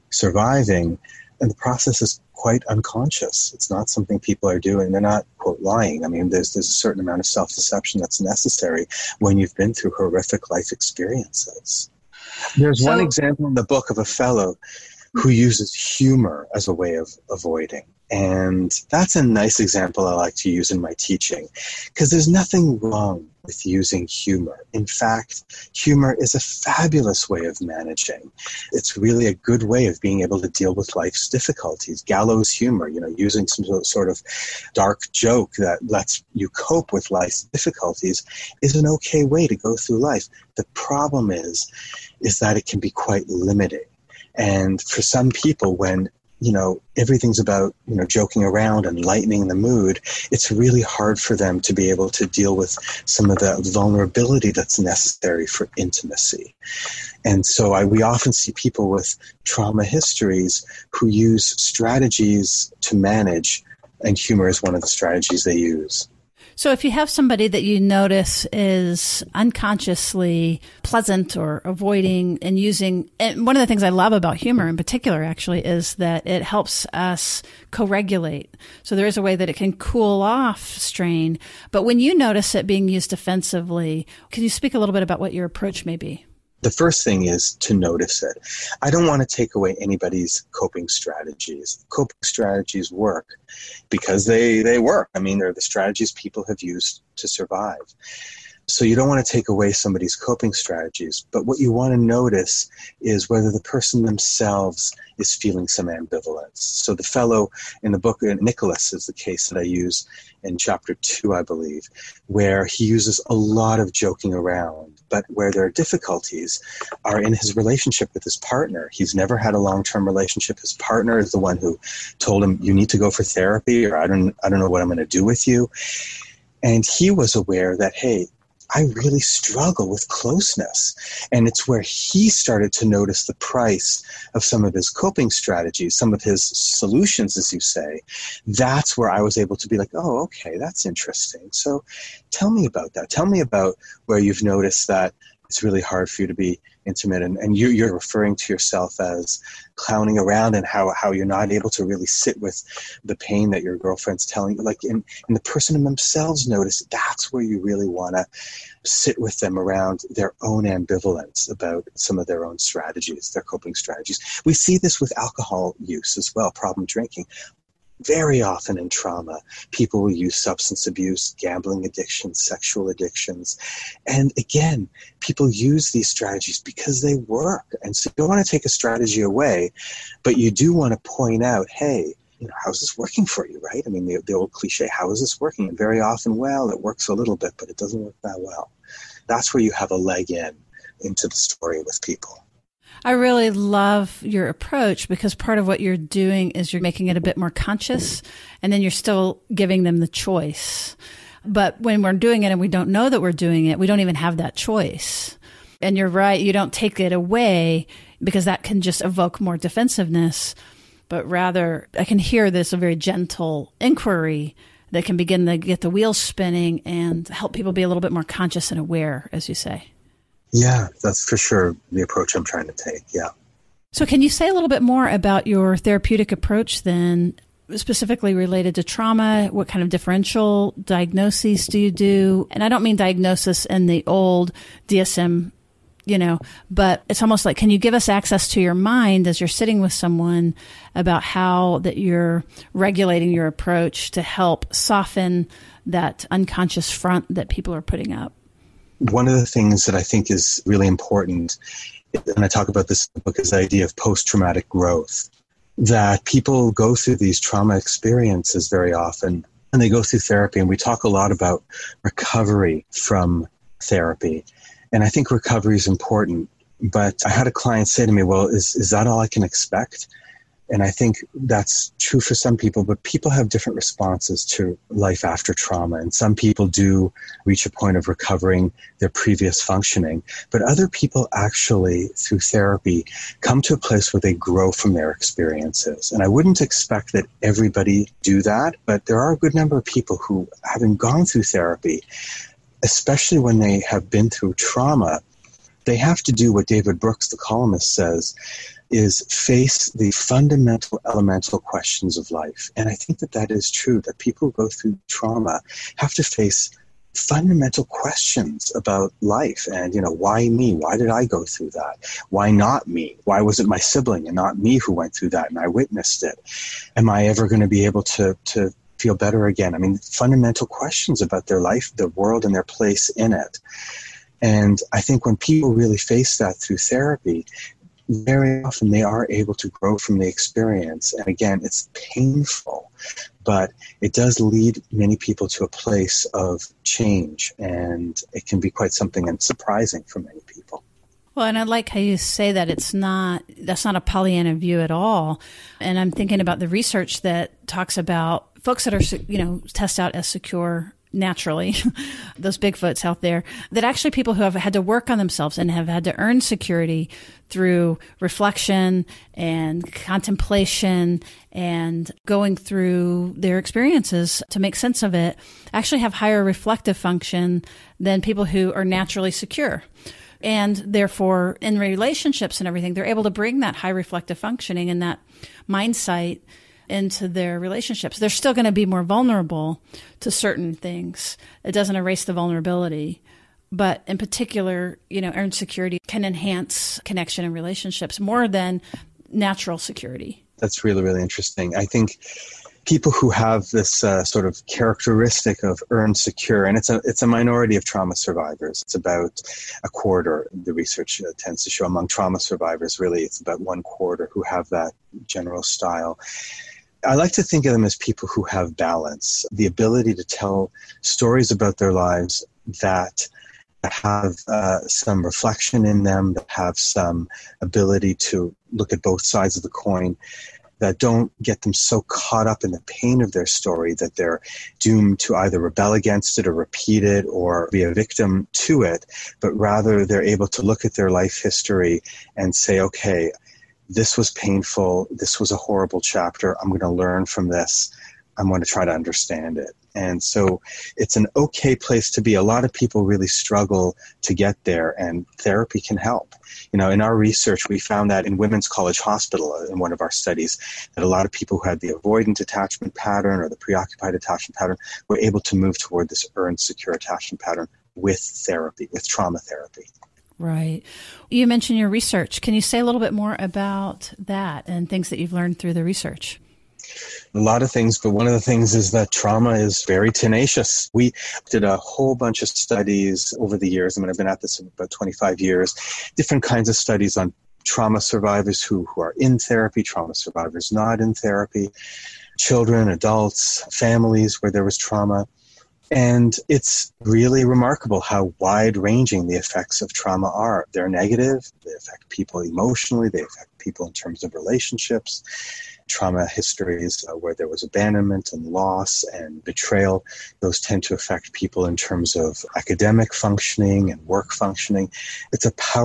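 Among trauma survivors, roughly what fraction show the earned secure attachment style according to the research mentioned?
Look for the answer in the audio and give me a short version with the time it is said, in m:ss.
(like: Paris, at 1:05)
One quarter, at 6:43.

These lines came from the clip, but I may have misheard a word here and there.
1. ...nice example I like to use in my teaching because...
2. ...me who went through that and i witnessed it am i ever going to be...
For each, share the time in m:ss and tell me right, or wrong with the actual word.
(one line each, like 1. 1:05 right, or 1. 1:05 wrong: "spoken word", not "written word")
1. 0:19 right
2. 5:14 right.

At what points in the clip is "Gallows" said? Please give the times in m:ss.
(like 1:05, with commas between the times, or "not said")
0:32.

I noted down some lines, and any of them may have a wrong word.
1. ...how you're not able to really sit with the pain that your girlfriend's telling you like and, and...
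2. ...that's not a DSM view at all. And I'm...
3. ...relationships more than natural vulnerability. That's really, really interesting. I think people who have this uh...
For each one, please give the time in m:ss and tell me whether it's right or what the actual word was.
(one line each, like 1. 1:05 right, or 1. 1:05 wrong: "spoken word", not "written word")
1. 2:30 right
2. 5:43 wrong: "Pollyanna", not "DSM"
3. 6:27 wrong: "security", not "vulnerability".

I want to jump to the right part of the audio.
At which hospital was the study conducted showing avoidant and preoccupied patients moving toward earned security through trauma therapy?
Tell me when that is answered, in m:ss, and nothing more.
7:28.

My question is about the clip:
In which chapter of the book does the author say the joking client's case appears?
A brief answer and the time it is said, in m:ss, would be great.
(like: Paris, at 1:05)
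Chapter 2, at 1:50.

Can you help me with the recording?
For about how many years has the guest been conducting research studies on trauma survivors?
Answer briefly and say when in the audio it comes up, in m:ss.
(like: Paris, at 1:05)
25 years, at 7:54.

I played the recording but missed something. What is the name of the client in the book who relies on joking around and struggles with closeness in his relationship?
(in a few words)
Nicholas.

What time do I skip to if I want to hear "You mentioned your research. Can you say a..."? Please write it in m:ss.
7:41.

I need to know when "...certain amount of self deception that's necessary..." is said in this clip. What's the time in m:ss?
0:06.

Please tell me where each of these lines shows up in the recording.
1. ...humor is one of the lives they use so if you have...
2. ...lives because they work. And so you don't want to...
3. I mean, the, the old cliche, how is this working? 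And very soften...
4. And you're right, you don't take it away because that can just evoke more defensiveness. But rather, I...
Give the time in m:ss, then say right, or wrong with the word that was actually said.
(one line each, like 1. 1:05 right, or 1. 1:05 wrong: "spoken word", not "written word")
1. 1:04 wrong: "strategies", not "lives"
2. 2:56 wrong: "strategies", not "lives"
3. 3:03 wrong: "often", not "soften"
4. 3:25 right.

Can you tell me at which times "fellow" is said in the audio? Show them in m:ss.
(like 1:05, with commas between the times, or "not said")
0:14, 1:47.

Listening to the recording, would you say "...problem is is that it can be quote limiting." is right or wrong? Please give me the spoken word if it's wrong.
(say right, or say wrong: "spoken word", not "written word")
wrong: "quite", not "quote".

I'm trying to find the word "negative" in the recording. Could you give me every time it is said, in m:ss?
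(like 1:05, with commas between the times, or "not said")
8:10.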